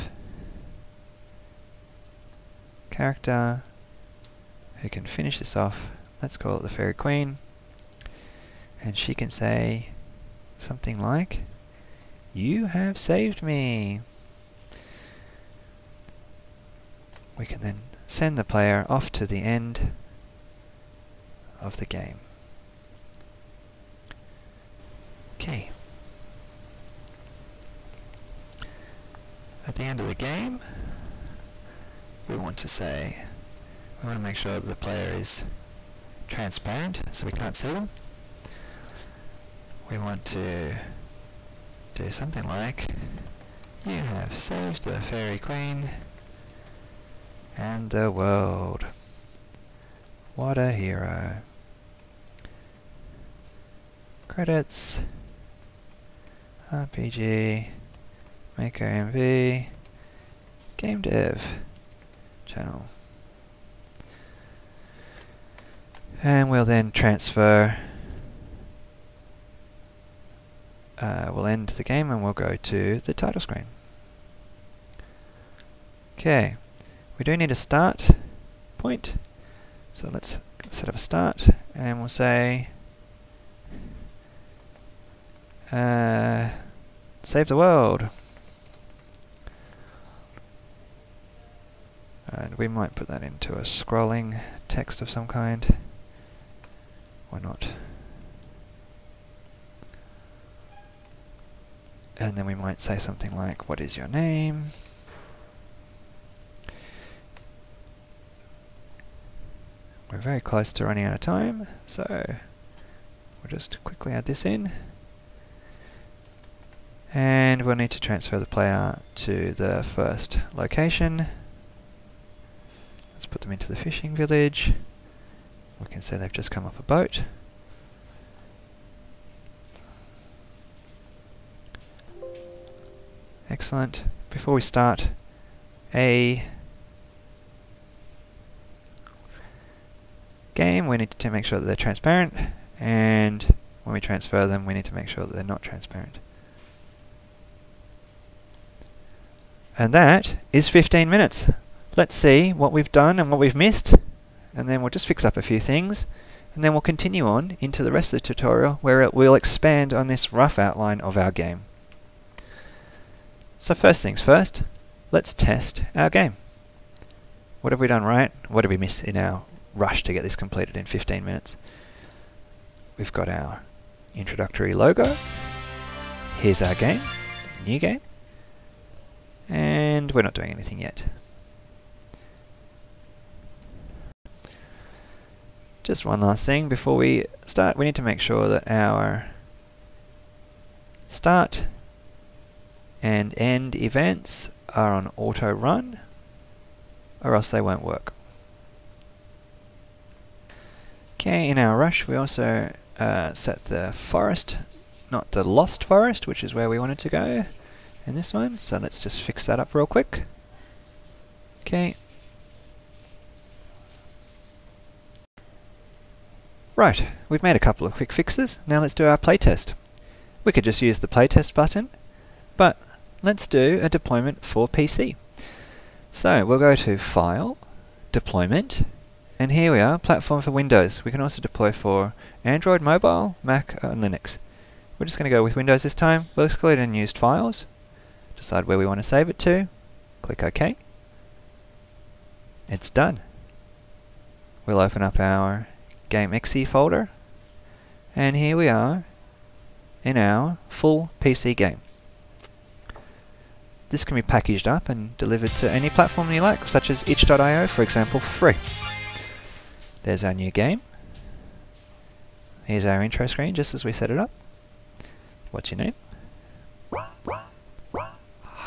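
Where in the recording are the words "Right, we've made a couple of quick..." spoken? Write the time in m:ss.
3:36.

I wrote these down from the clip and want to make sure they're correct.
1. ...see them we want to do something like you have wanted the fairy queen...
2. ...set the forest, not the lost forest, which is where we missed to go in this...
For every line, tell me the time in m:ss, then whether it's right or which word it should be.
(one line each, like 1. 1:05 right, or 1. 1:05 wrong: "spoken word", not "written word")
1. 0:37 wrong: "saved", not "wanted"
2. 3:23 wrong: "wanted", not "missed".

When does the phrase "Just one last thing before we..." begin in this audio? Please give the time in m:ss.
3:05.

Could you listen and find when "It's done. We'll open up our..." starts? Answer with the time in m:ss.
4:02.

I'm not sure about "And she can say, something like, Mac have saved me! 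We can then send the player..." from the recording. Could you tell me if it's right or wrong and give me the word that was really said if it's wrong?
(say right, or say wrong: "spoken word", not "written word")
wrong: "You", not "Mac".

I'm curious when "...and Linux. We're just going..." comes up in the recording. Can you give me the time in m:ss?
3:53.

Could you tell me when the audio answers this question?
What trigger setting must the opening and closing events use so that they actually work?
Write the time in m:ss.
3:15.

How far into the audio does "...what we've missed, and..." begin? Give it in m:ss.
2:33.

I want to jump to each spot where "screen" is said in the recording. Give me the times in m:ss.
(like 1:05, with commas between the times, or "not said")
1:13, 4:23.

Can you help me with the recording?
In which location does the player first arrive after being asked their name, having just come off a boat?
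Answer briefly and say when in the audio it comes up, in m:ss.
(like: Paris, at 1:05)
fishing village, at 2:03.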